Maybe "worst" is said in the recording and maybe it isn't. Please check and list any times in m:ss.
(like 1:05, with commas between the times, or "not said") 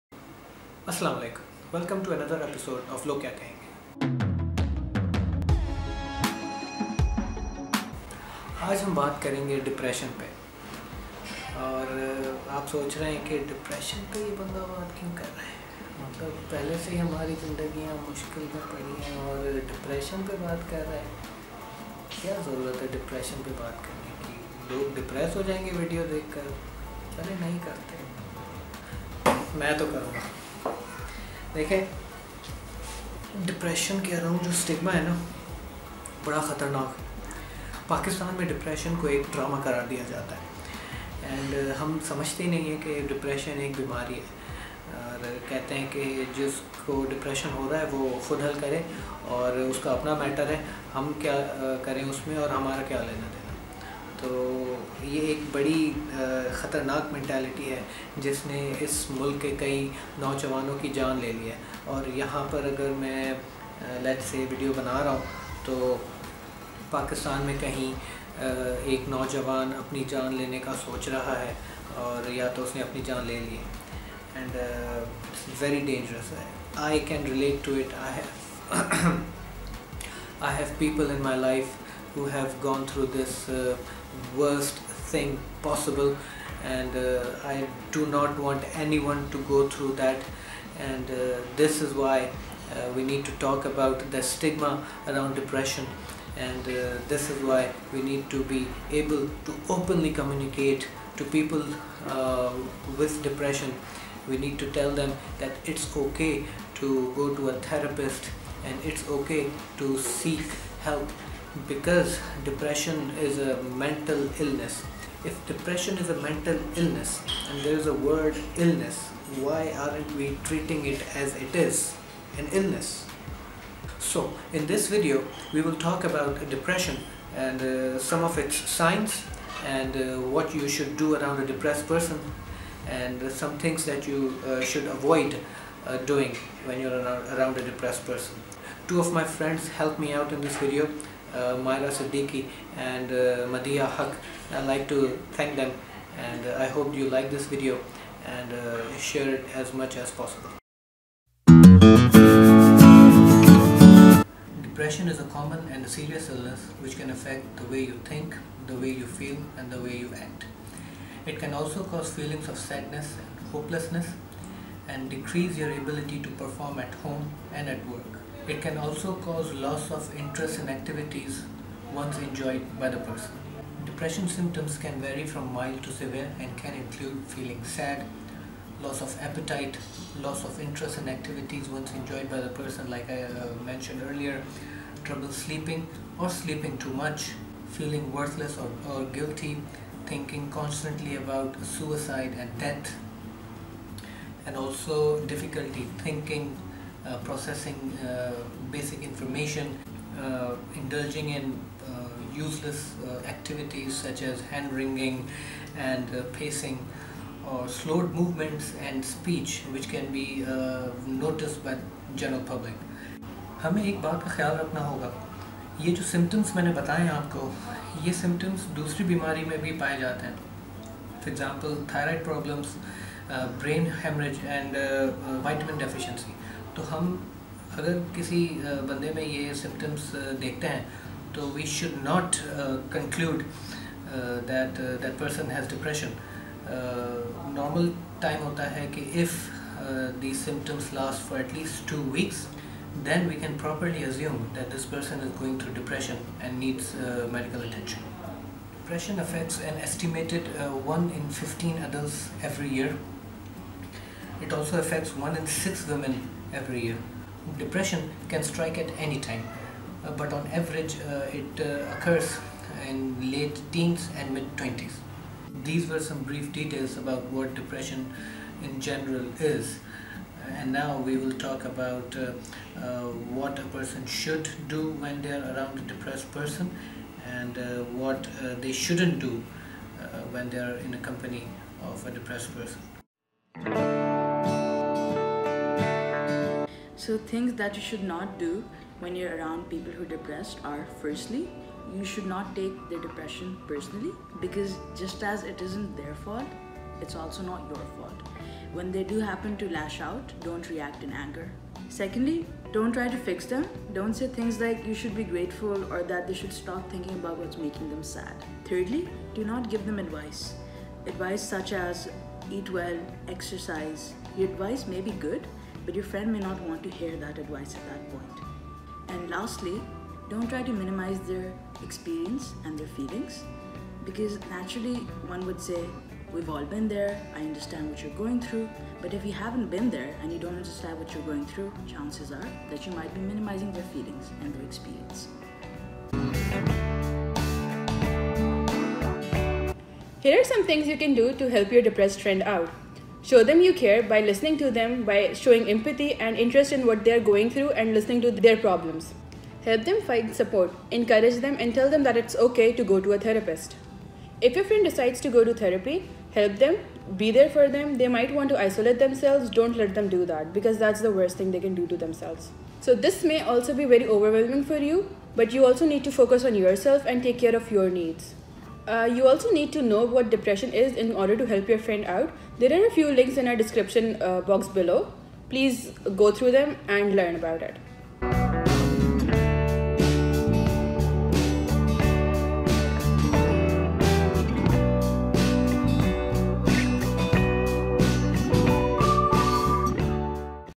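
1:24, 6:01.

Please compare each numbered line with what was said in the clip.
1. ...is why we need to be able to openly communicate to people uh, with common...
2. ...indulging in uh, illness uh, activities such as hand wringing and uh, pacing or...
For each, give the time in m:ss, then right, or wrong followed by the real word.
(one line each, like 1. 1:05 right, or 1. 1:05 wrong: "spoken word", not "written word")
1. 1:37 wrong: "depression", not "common"
2. 3:20 wrong: "useless", not "illness".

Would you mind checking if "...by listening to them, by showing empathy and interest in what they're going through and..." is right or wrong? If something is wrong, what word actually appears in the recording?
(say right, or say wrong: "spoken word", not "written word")
right.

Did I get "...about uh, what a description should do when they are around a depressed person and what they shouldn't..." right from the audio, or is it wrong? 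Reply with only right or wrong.
wrong.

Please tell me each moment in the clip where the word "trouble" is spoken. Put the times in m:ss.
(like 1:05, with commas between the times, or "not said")
3:05.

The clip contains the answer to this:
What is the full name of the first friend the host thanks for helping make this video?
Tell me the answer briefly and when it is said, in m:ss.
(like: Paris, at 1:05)
Maira Siddiqui, at 2:21.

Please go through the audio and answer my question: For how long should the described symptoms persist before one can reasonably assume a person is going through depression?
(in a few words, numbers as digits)
2 weeks.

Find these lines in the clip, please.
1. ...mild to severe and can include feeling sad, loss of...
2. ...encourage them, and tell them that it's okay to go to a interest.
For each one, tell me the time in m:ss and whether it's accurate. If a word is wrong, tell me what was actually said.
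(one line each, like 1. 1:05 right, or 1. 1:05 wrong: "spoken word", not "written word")
1. 2:55 right
2. 5:50 wrong: "therapist", not "interest".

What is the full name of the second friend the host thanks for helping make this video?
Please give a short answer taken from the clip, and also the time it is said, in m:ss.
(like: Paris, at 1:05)
Madiha Haque, at 2:23.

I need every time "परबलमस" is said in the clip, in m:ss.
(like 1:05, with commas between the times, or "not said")
3:42.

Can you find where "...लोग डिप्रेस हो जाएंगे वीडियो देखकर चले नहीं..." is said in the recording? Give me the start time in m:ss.
0:24.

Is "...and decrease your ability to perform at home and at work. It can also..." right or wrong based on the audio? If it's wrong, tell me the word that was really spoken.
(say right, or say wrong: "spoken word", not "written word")
right.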